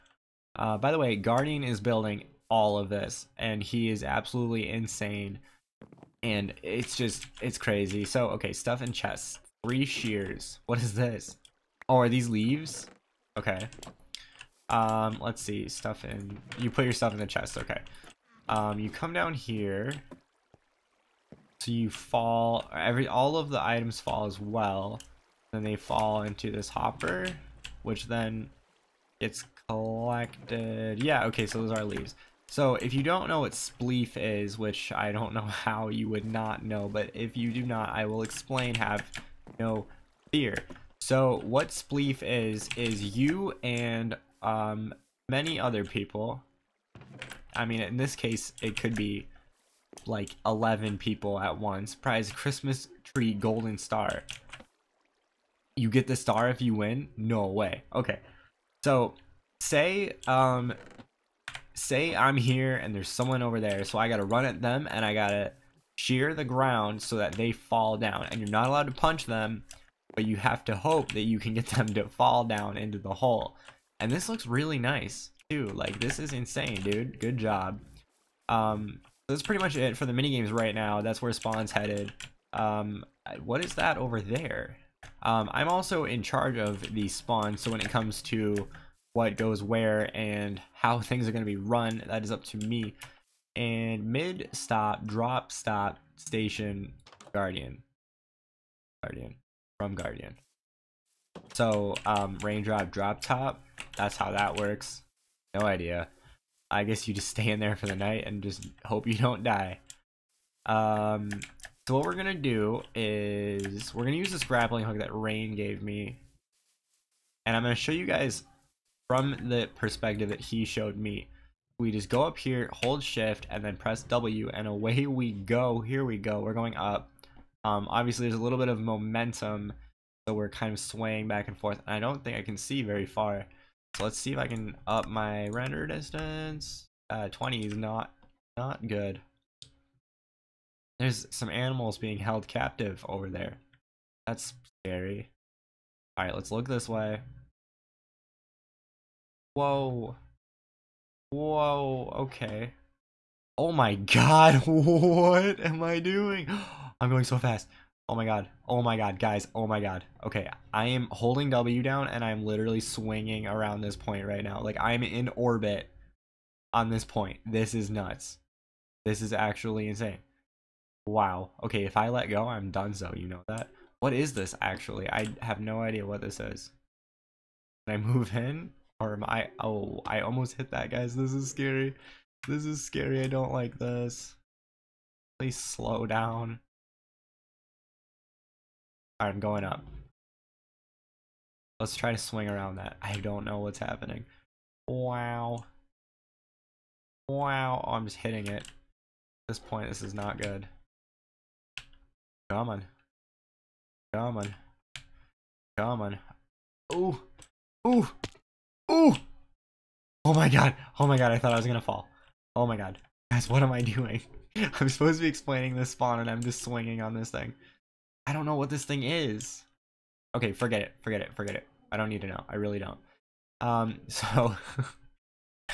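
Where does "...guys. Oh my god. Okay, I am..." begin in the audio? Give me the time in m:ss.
2:39.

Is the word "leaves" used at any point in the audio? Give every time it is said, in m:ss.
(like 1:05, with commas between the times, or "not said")
0:12, 0:31.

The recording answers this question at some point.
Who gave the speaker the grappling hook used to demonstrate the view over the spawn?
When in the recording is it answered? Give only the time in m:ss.
1:55.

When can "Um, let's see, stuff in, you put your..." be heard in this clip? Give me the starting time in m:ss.
0:14.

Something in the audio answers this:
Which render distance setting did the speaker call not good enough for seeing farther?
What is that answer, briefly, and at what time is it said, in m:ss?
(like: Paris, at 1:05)
20, at 2:17.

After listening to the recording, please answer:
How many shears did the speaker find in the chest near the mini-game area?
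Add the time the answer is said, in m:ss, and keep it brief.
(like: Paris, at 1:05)
3, at 0:09.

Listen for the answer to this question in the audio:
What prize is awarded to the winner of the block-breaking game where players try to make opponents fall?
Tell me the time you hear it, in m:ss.
0:52.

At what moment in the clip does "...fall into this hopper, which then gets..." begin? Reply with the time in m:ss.
0:25.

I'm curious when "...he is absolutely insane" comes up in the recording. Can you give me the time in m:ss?
0:03.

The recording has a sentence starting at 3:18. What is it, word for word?
At this point, this is not good.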